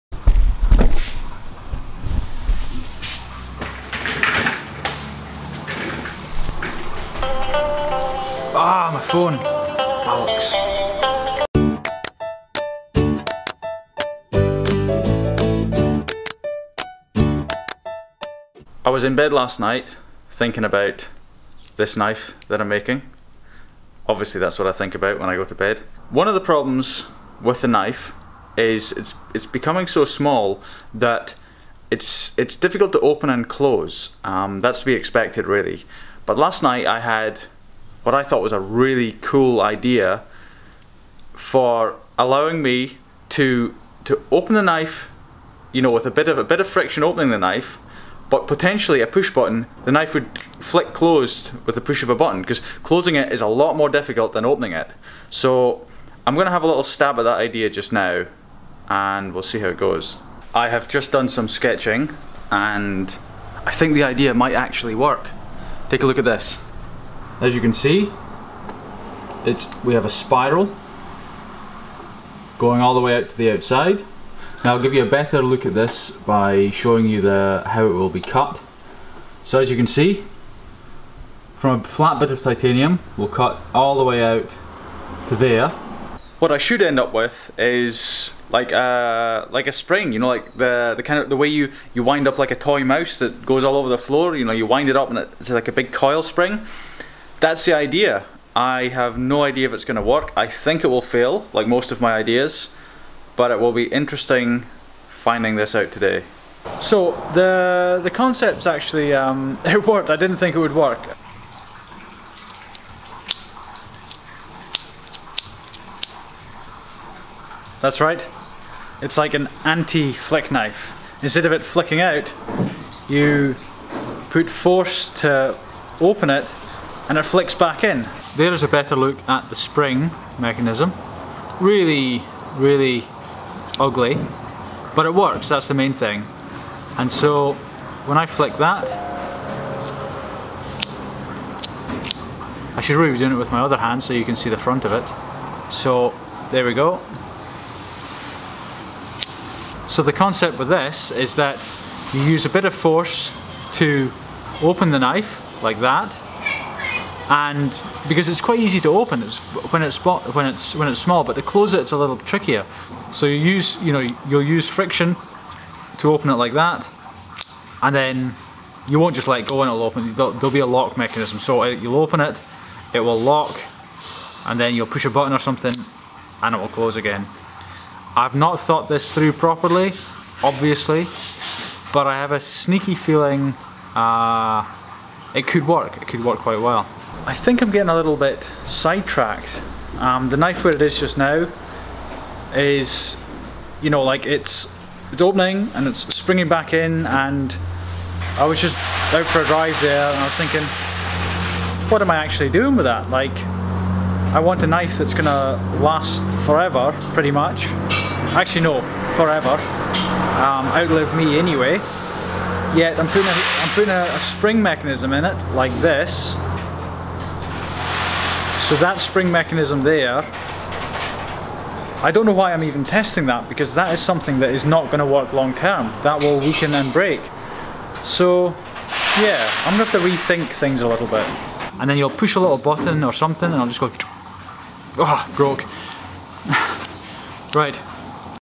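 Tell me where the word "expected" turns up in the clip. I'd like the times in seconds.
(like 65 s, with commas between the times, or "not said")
34 s.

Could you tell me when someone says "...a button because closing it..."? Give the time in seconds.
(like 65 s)
52 s.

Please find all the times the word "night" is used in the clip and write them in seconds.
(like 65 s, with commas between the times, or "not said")
19 s, 36 s.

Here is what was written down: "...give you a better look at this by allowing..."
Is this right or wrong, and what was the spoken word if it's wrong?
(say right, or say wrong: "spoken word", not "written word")
wrong: "showing", not "allowing".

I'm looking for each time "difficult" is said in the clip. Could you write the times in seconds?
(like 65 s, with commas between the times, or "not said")
32 s, 53 s.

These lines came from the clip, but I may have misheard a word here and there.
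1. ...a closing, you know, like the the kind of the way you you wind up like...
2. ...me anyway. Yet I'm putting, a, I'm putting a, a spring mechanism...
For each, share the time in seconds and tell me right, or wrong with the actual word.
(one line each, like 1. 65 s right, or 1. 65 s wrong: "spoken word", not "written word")
1. 89 s wrong: "spring", not "closing"
2. 211 s right.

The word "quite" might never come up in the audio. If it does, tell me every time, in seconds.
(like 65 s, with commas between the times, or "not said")
158 s, 186 s.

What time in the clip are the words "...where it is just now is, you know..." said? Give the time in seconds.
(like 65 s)
190 s.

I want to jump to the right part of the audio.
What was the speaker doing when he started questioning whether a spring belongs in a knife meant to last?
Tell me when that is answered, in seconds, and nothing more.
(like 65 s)
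199 s.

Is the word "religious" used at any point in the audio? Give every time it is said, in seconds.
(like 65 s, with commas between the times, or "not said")
not said.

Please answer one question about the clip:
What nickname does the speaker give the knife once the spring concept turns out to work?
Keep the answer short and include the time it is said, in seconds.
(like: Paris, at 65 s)
anti-flick knife, at 119 s.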